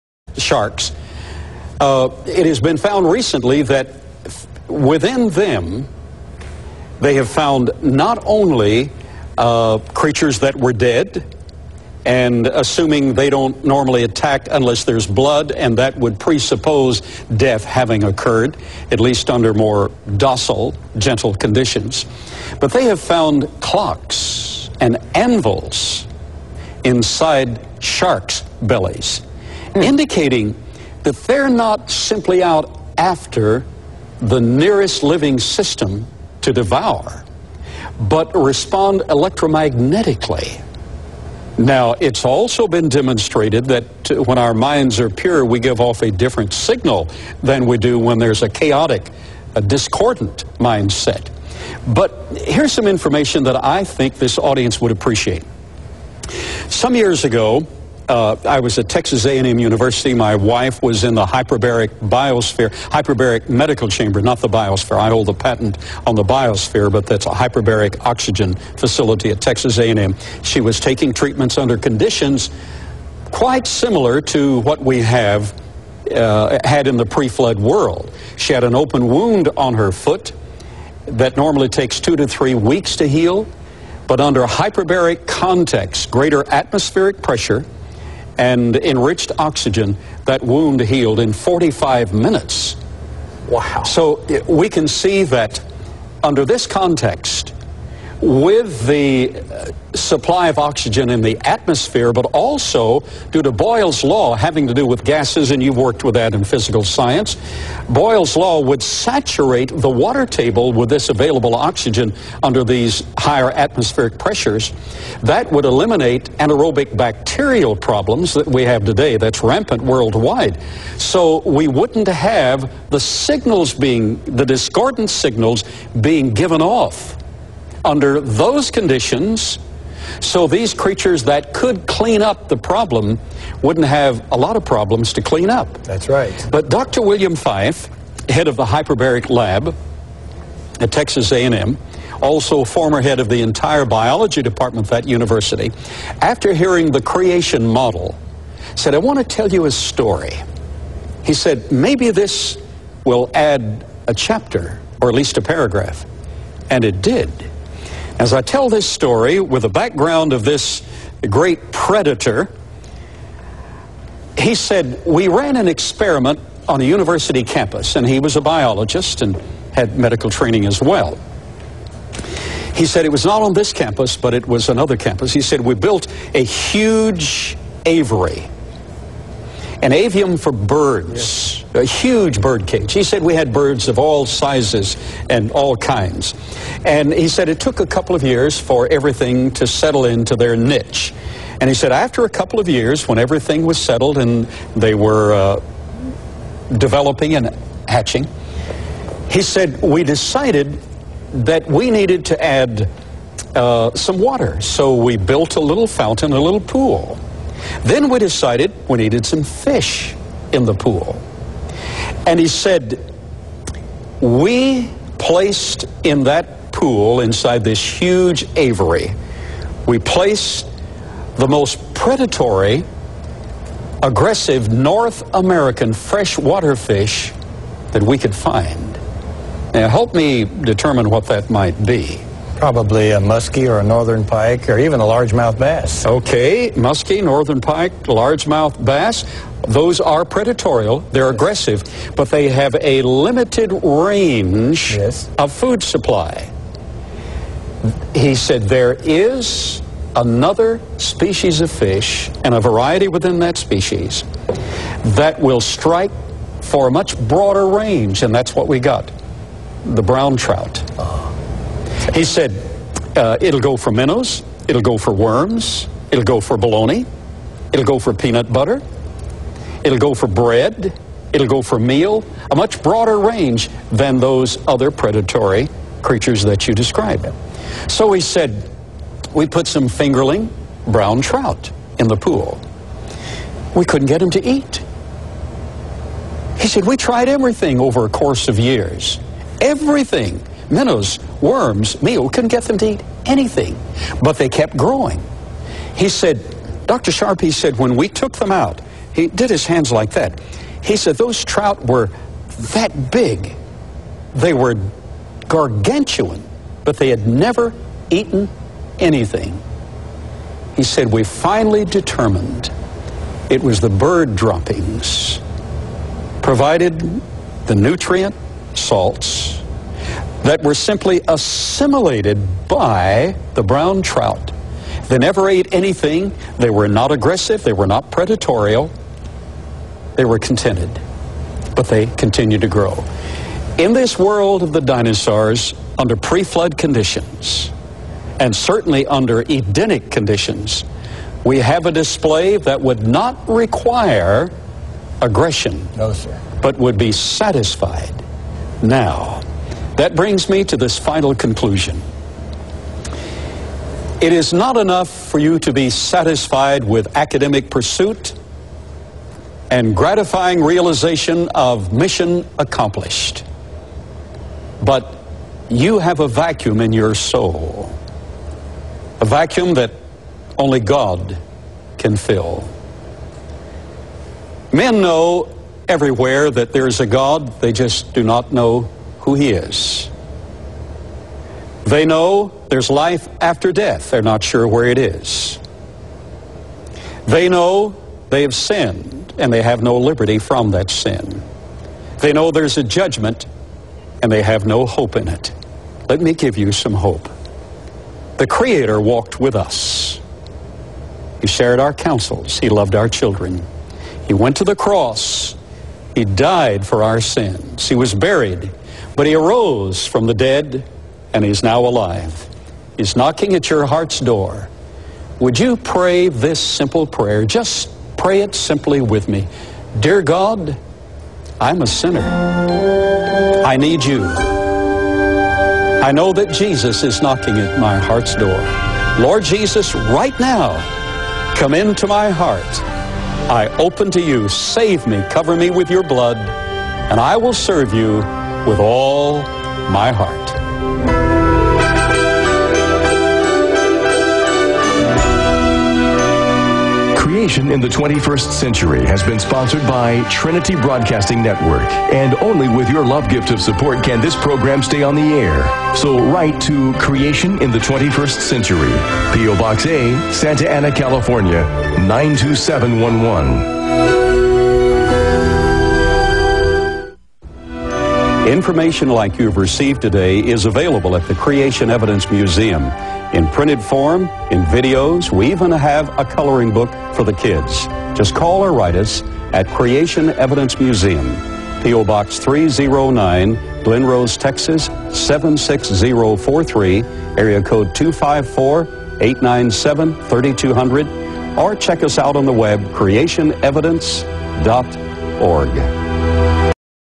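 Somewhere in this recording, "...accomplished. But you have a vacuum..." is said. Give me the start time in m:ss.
6:02.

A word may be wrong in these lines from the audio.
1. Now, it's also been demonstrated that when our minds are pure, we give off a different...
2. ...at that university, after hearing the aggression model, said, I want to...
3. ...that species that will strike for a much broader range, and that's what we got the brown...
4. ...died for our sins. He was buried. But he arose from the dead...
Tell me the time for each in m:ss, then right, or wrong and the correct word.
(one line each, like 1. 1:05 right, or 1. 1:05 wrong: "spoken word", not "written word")
1. 0:41 right
2. 2:24 wrong: "creation", not "aggression"
3. 4:13 right
4. 6:46 right.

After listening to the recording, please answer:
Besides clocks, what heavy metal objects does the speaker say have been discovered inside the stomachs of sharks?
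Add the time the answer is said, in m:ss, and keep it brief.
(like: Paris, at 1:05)
Anvils, at 0:25.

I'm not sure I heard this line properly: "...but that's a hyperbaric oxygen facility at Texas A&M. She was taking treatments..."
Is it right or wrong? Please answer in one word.
right.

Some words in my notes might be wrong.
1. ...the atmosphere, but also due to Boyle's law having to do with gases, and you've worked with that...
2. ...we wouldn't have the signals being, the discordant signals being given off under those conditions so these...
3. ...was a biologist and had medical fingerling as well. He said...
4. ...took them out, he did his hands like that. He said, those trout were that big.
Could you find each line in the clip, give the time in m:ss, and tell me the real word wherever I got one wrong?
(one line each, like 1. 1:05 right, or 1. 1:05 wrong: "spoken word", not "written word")
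1. 1:41 right
2. 2:01 right
3. 2:48 wrong: "training", not "fingerling"
4. 4:58 right.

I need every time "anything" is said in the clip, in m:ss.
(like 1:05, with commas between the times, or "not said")
4:53, 5:08, 5:25.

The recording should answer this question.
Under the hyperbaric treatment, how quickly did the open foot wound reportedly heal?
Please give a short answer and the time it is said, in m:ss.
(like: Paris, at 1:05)
45 minutes, at 1:31.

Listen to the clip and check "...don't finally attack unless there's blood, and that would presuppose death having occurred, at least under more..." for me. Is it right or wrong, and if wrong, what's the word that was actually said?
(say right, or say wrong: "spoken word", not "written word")
wrong: "normally", not "finally".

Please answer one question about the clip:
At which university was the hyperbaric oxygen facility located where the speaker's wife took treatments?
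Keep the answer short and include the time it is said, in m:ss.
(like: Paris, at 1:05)
Texas A&M University, at 0:58.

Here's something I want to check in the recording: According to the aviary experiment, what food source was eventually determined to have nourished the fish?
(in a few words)
Bird droppings.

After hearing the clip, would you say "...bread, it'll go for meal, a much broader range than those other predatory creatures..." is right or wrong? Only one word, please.
right.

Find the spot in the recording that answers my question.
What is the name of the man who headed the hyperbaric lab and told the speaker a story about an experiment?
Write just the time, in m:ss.
2:16.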